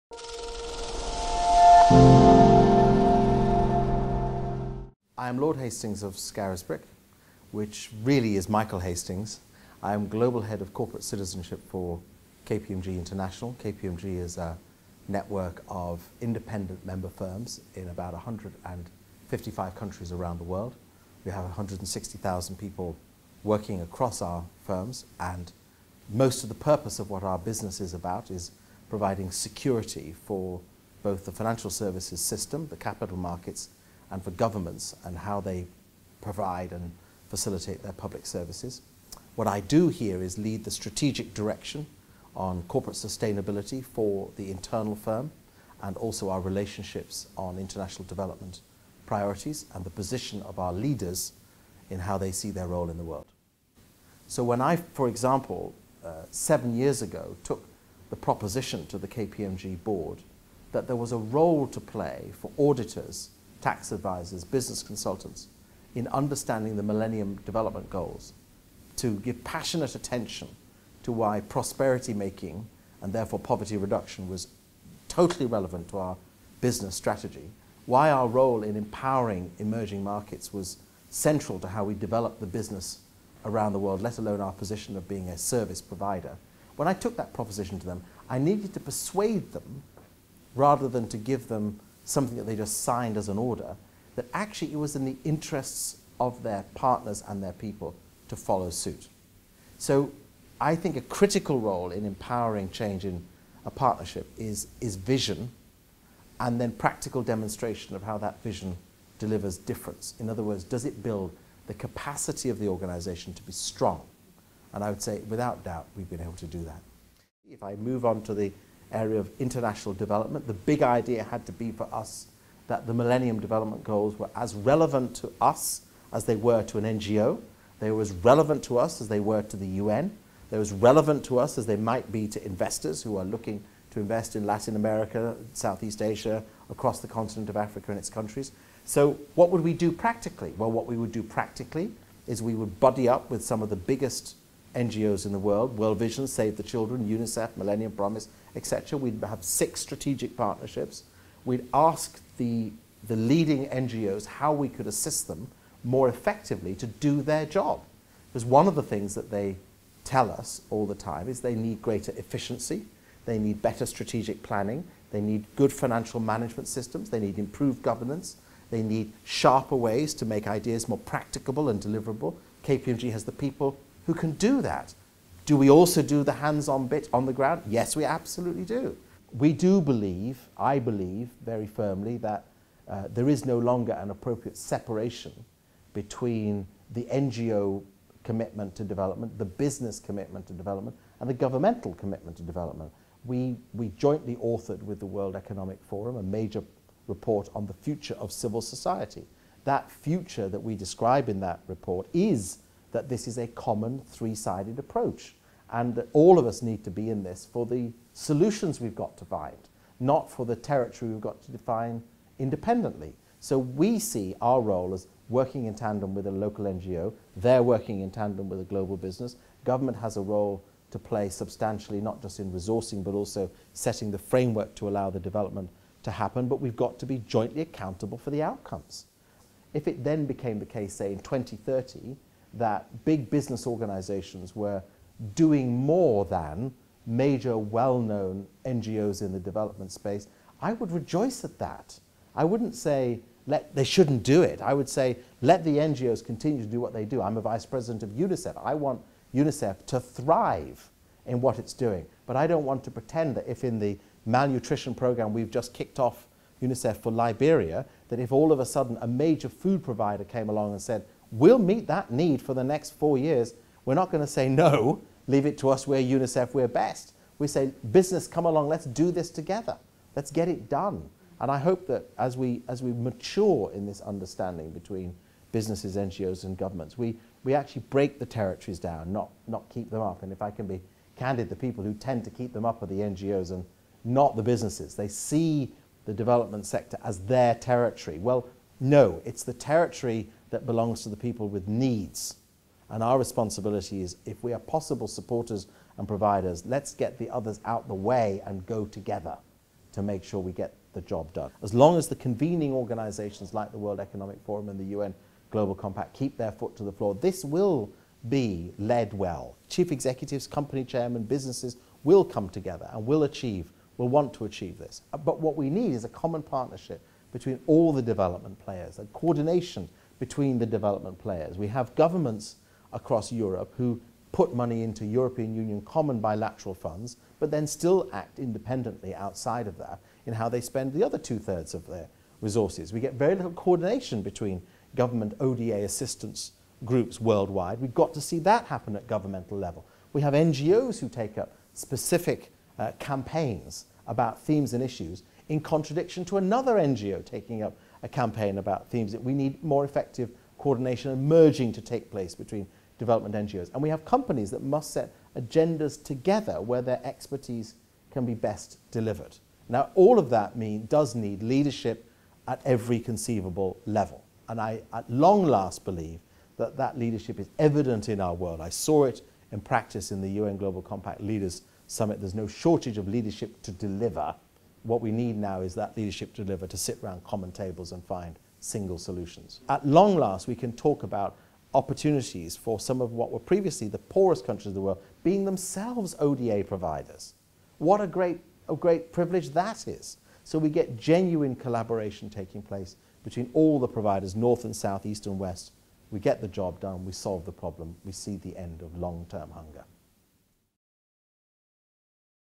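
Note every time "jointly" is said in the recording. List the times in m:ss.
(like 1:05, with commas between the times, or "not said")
3:13, 3:47.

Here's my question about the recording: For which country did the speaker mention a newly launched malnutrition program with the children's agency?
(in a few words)
Liberia.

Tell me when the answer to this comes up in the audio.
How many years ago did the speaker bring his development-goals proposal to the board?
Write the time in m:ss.
0:56.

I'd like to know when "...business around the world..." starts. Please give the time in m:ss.
1:22.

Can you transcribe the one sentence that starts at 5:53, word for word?
And we have companies that must set agendas together where their expertise can be best delivered.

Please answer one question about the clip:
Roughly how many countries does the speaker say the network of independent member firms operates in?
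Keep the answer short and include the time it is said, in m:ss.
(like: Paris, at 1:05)
155, at 0:18.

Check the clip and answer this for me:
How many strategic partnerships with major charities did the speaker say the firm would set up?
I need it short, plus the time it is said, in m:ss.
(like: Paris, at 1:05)
6, at 2:29.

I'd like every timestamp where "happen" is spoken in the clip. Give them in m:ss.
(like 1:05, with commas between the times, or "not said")
3:46, 5:38.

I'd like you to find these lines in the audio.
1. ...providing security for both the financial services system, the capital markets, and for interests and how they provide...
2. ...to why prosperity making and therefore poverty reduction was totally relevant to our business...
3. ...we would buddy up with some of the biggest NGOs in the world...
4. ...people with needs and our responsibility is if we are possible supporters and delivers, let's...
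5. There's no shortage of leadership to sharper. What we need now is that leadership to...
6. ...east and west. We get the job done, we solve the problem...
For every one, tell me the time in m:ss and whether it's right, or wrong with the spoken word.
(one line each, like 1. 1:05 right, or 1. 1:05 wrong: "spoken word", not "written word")
1. 0:28 wrong: "governments", not "interests"
2. 1:11 right
3. 2:22 right
4. 4:51 wrong: "providers", not "delivers"
5. 6:12 wrong: "deliver", not "sharper"
6. 6:35 right.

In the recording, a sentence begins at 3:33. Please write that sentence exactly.
So we see our role as working in tandem with a local NGO, they're working in tandem with a global business.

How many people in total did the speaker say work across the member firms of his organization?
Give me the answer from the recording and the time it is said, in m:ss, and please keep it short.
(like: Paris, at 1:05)
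160,000, at 0:21.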